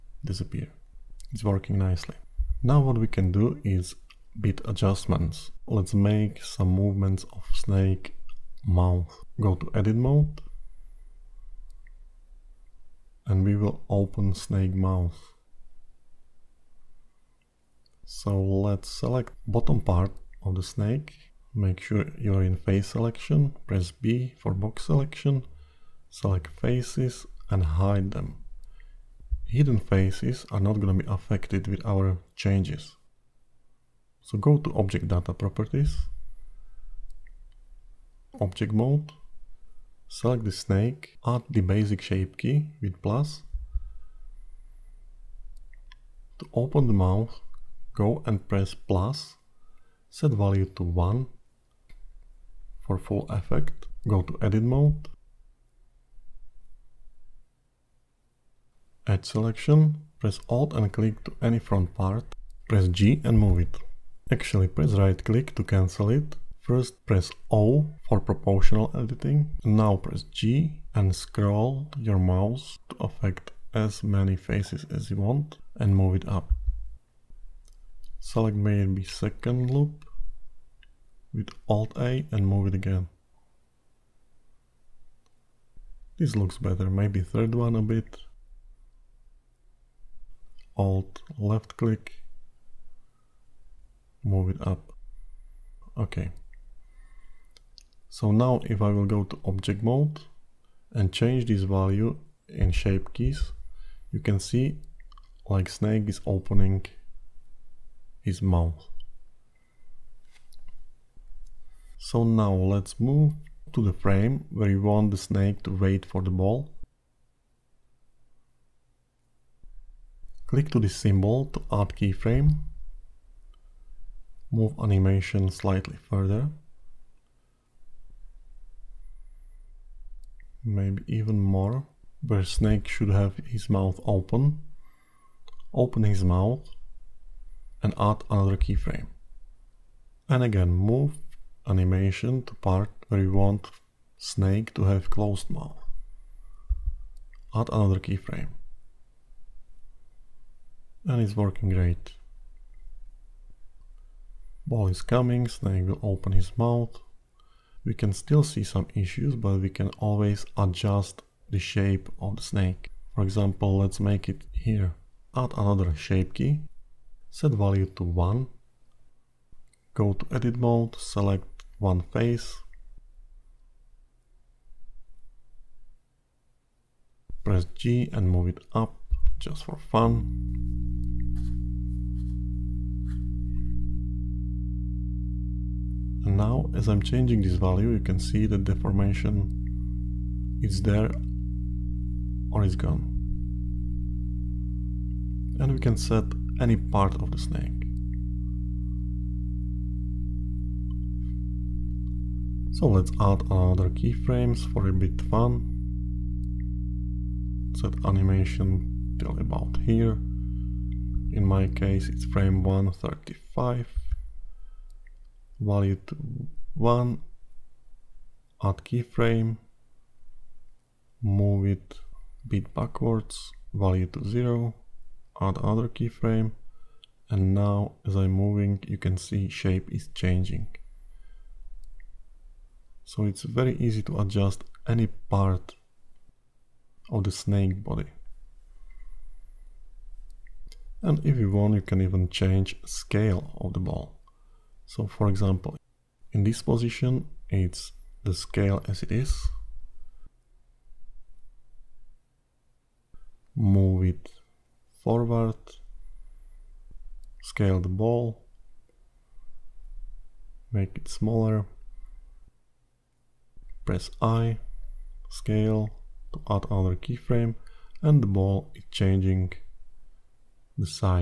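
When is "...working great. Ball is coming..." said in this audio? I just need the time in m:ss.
2:31.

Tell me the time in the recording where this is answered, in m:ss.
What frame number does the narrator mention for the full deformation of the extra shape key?
3:32.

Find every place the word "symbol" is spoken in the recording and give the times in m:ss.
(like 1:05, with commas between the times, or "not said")
2:00.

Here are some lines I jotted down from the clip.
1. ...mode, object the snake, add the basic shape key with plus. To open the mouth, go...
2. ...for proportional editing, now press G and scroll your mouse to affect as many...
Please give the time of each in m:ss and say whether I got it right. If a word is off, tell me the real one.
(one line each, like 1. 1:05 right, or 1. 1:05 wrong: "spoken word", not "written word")
1. 0:38 wrong: "select", not "object"
2. 1:08 right.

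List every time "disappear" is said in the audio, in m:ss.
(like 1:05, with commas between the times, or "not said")
0:00.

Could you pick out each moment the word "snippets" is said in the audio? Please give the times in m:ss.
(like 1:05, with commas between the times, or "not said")
not said.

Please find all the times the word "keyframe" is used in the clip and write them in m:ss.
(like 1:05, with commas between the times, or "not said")
2:01, 2:18, 2:27, 3:23, 3:38, 3:45, 4:26.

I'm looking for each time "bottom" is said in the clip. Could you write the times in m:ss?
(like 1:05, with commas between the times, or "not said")
0:19.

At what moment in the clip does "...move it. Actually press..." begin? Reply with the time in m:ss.
1:03.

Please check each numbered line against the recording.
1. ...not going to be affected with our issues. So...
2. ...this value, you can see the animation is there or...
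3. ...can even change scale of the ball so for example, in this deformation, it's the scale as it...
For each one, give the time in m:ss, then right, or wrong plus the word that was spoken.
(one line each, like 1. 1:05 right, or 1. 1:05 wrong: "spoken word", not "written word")
1. 0:30 wrong: "changes", not "issues"
2. 3:07 wrong: "deformation", not "animation"
3. 4:01 wrong: "position", not "deformation".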